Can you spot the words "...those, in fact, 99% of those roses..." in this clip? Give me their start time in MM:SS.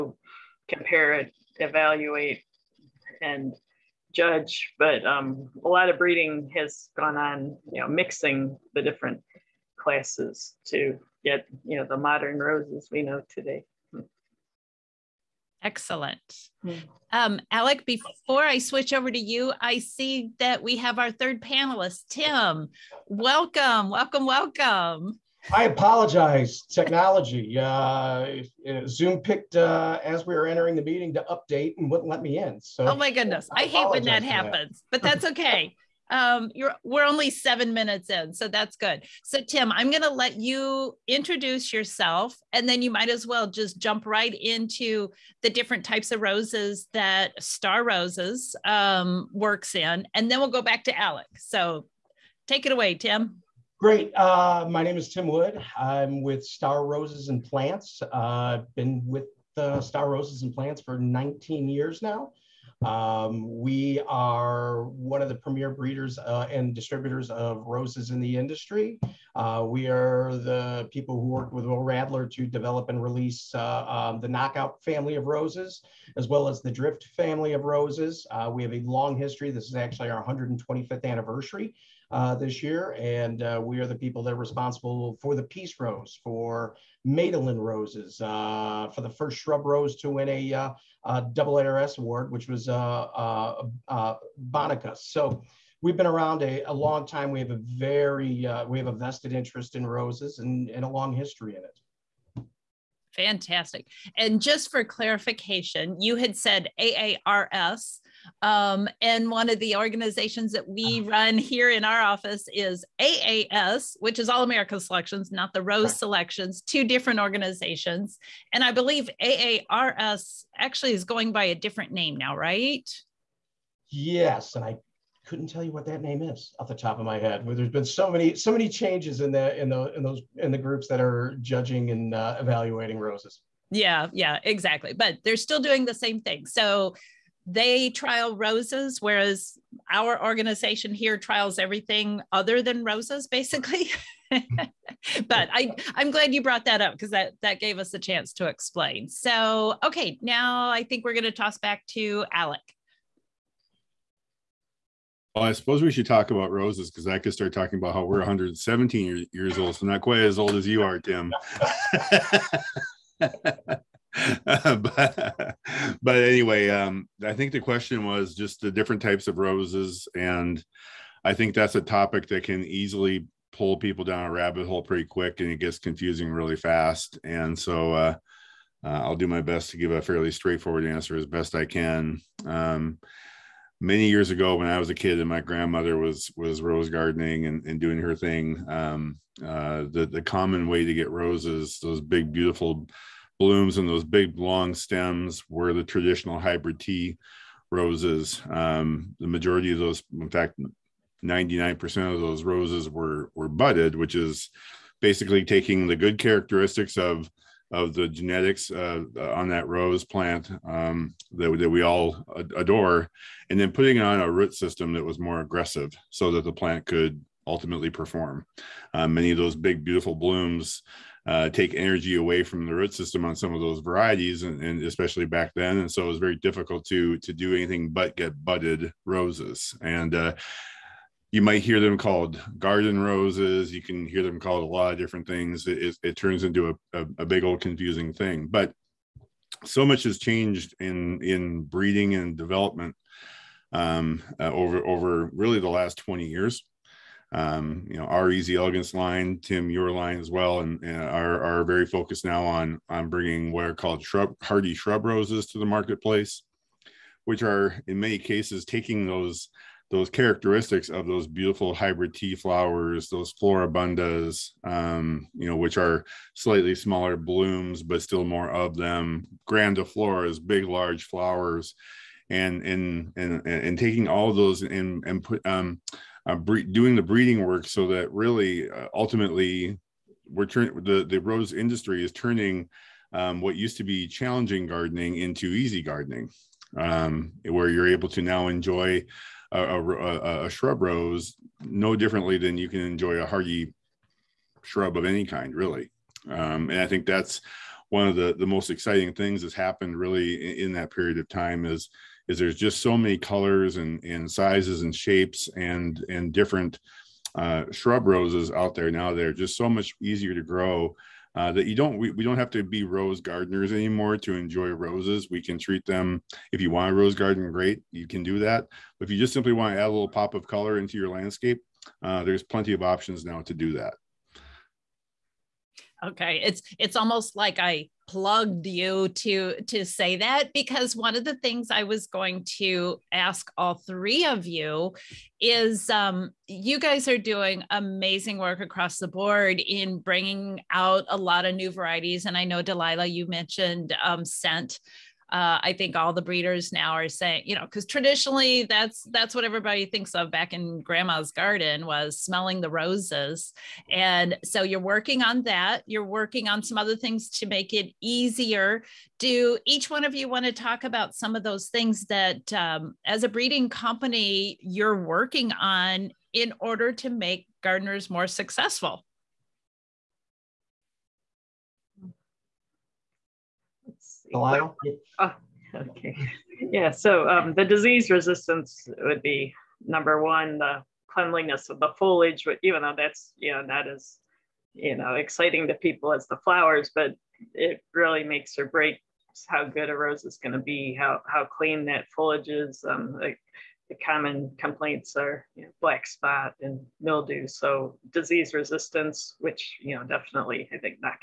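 03:19.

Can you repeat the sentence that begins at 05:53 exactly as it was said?
And so you're working on that.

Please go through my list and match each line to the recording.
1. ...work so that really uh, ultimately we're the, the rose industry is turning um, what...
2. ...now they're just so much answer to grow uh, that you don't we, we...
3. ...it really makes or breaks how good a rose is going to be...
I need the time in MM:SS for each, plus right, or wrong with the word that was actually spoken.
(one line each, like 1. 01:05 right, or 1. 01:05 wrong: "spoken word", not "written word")
1. 04:37 right
2. 05:08 wrong: "easier", not "answer"
3. 06:27 right.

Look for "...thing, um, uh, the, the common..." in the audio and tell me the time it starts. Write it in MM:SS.
03:08.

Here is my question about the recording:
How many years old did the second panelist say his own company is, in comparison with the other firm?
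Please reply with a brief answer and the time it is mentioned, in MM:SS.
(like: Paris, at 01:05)
117, at 02:38.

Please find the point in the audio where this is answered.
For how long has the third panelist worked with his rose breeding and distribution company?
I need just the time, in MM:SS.
01:00.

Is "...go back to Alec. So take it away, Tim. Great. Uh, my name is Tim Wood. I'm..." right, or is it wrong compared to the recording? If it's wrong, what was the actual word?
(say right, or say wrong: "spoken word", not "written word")
right.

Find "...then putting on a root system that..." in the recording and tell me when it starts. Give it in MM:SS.
03:33.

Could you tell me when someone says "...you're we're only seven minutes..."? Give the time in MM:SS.
00:36.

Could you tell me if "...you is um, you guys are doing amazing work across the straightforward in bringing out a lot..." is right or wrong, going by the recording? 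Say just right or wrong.
wrong.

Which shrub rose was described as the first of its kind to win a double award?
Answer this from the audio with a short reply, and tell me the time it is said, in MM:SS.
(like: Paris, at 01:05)
Bonica, at 01:34.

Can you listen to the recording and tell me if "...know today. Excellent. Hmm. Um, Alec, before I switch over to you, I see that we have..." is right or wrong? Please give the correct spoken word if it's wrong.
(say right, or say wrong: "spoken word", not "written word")
right.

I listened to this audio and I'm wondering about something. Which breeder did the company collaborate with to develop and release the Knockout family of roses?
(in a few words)
Will Radler.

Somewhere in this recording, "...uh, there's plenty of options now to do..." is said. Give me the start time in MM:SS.
05:22.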